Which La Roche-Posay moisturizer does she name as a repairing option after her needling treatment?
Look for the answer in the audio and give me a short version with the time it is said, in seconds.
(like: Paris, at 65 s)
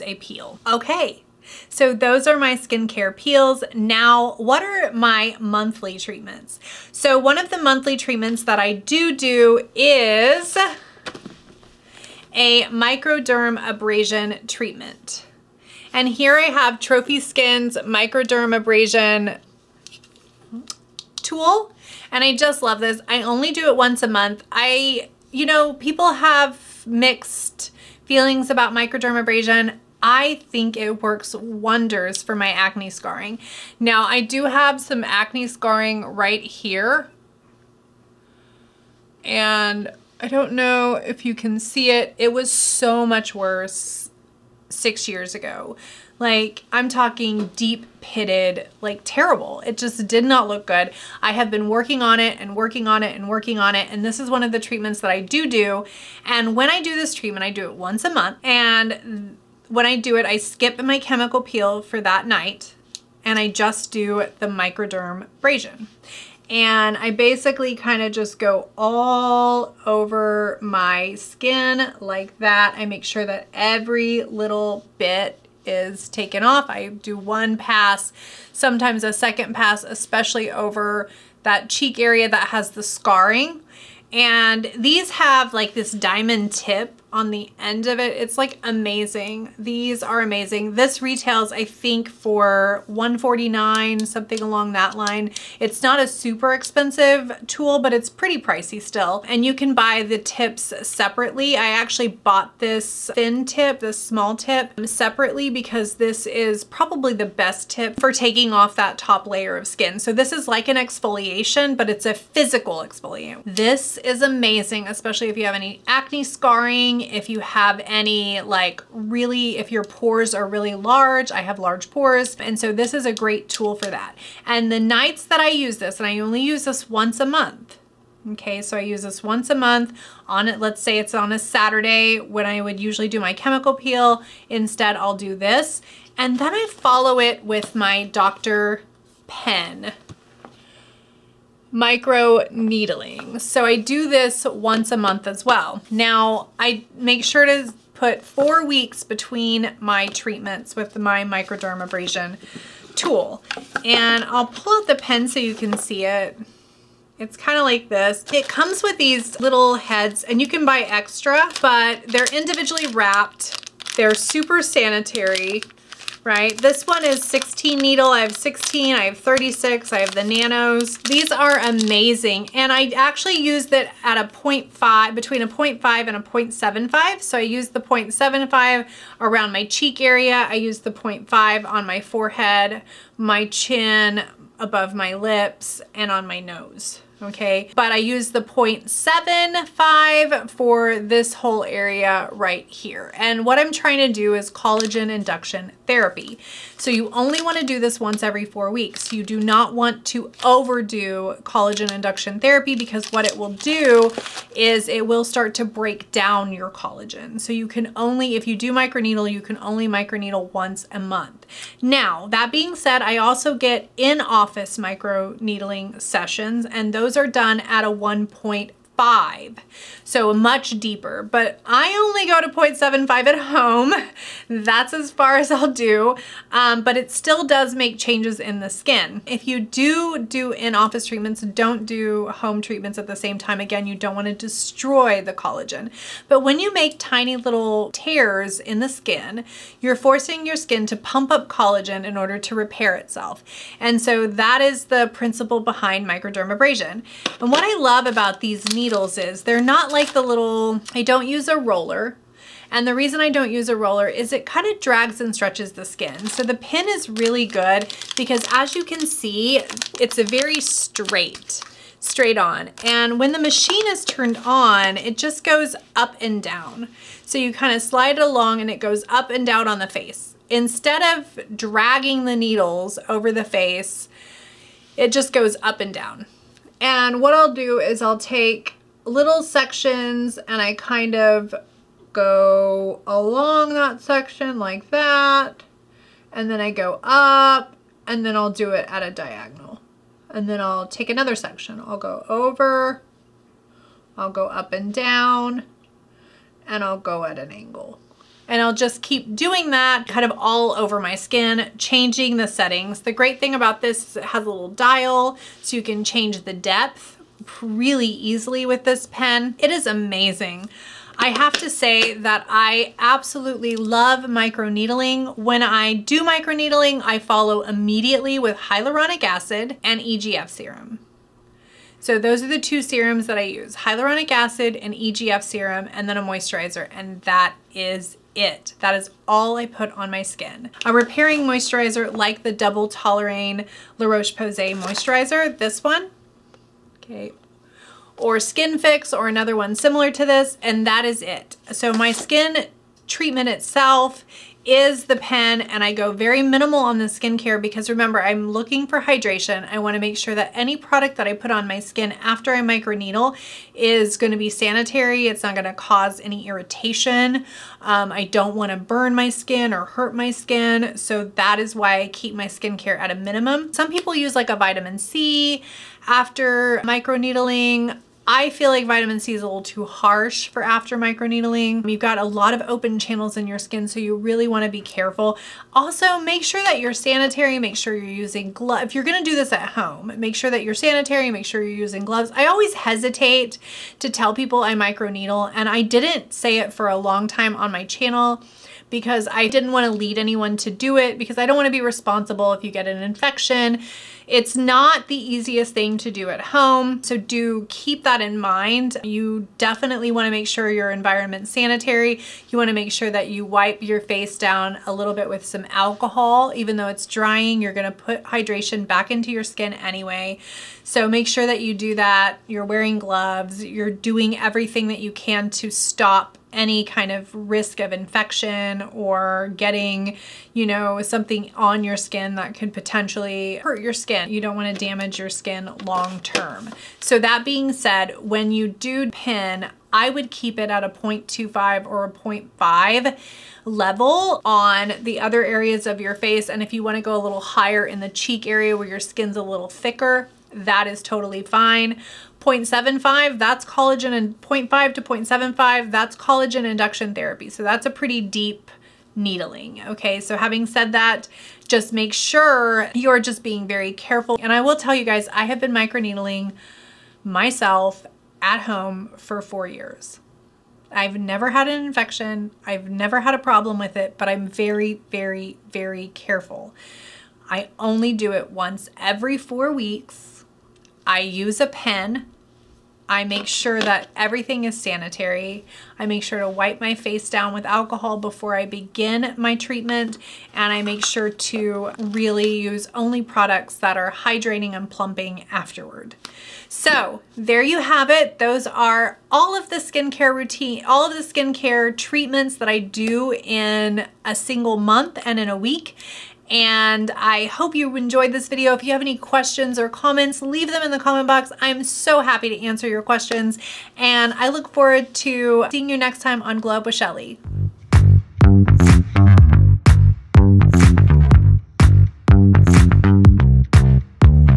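Double Toleriane, at 332 s.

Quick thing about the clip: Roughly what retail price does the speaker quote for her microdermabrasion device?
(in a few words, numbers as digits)
149.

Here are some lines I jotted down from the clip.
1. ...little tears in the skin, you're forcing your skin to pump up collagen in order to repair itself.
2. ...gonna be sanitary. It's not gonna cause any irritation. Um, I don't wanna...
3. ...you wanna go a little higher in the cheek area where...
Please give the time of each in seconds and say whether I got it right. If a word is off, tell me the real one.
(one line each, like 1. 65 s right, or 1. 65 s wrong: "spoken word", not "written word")
1. 237 s right
2. 354 s right
3. 436 s right.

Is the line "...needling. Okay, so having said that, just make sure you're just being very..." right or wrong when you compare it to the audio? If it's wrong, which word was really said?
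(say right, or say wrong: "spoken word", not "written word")
right.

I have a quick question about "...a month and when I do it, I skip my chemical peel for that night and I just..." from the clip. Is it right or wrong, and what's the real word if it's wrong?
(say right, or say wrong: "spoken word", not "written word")
right.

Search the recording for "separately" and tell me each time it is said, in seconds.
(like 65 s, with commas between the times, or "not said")
100 s, 104 s.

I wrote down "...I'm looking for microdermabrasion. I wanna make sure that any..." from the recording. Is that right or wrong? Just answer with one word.
wrong.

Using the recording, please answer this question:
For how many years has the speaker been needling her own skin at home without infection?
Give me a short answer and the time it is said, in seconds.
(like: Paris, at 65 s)
4 years, at 459 s.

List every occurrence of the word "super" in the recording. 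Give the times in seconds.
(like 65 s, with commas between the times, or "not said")
96 s, 164 s.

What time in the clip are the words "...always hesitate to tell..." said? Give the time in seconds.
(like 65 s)
382 s.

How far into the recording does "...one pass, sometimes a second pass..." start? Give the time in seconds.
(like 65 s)
77 s.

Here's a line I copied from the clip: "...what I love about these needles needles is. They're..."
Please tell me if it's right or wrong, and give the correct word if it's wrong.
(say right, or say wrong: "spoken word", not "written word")
right.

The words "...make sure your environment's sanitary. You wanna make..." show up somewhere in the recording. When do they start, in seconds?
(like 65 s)
400 s.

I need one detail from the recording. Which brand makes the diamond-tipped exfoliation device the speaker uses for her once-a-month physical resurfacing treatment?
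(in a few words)
Trophy Skin.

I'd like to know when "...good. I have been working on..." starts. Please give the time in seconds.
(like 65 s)
50 s.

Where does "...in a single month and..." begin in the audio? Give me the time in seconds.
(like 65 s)
493 s.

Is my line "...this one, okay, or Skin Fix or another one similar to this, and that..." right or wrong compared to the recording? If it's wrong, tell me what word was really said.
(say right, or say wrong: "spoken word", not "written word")
right.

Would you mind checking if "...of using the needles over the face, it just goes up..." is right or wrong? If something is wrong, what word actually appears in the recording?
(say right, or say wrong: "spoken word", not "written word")
wrong: "dragging", not "using".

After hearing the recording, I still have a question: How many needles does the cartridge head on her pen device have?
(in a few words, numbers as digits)
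16.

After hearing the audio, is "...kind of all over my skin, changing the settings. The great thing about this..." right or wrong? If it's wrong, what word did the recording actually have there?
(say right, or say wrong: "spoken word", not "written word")
right.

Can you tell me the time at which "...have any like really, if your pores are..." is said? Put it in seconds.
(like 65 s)
117 s.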